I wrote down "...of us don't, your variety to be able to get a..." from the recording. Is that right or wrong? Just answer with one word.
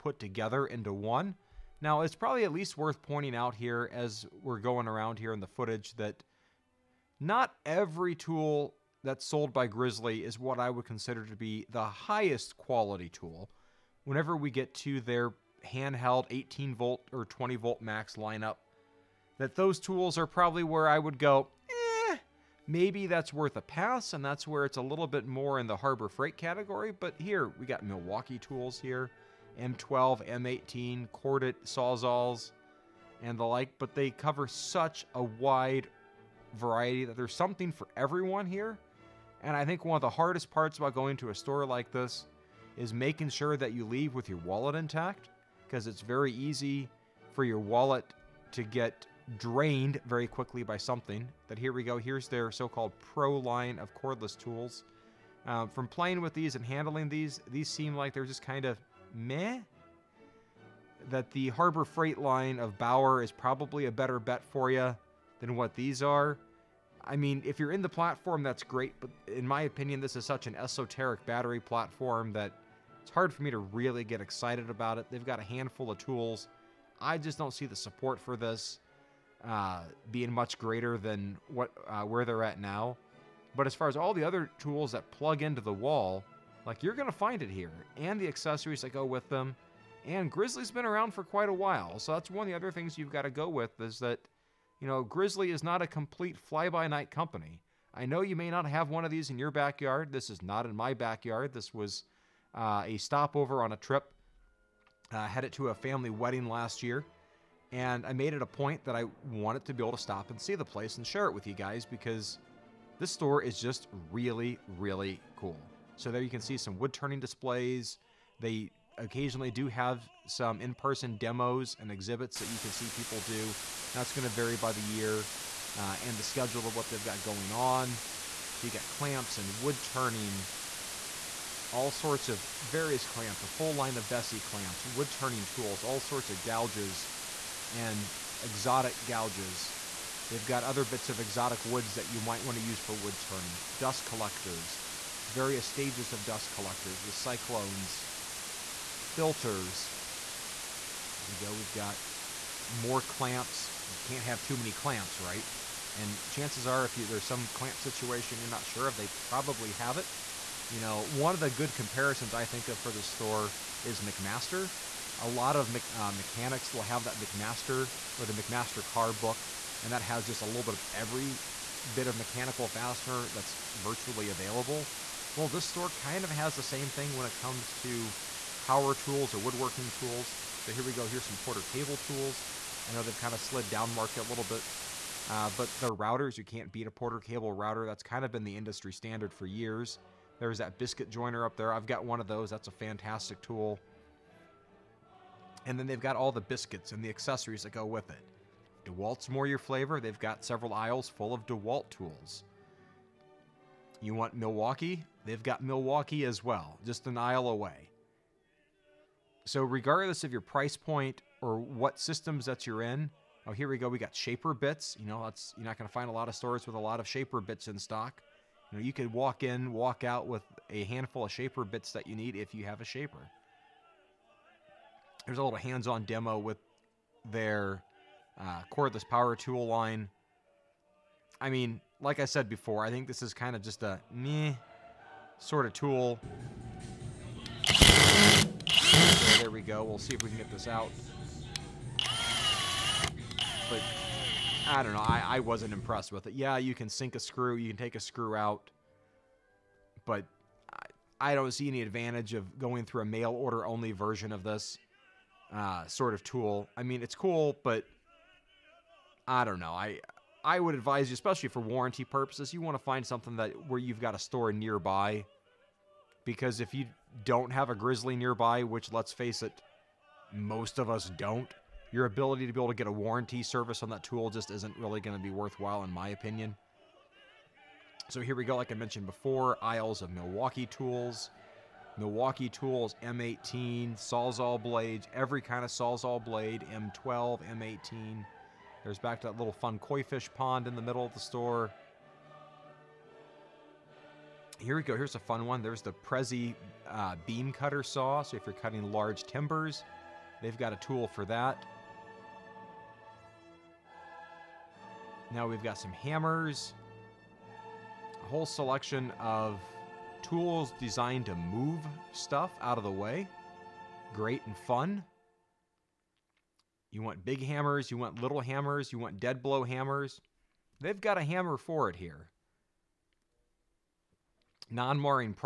wrong.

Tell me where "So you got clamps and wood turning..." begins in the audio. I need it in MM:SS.
02:08.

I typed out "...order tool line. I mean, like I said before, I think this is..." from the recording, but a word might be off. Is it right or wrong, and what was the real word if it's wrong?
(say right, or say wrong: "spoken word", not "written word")
wrong: "power", not "order".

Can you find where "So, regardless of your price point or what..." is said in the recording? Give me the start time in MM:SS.
03:29.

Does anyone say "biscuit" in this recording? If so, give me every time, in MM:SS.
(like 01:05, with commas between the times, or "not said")
03:10, 03:16.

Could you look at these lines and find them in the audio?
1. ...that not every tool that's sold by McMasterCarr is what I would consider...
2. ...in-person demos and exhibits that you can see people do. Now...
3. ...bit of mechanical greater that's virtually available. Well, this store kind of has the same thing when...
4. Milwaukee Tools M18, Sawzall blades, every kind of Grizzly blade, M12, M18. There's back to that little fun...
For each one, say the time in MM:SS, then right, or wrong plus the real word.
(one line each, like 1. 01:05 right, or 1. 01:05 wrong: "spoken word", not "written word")
1. 00:05 wrong: "Grizzly", not "McMasterCarr"
2. 02:00 right
3. 02:51 wrong: "fastener", not "greater"
4. 04:41 wrong: "Sawzall", not "Grizzly".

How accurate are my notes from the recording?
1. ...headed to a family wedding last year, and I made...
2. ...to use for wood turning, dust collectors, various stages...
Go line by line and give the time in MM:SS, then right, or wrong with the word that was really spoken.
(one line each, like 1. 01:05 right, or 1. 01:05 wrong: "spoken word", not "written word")
1. 01:45 right
2. 02:22 right.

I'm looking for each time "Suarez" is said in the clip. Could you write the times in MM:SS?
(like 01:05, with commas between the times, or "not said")
not said.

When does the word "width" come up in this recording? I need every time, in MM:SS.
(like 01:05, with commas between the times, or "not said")
not said.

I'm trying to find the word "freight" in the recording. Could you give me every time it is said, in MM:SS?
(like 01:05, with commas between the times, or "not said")
00:26, 01:01.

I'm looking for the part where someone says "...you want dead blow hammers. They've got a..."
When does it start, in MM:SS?
05:18.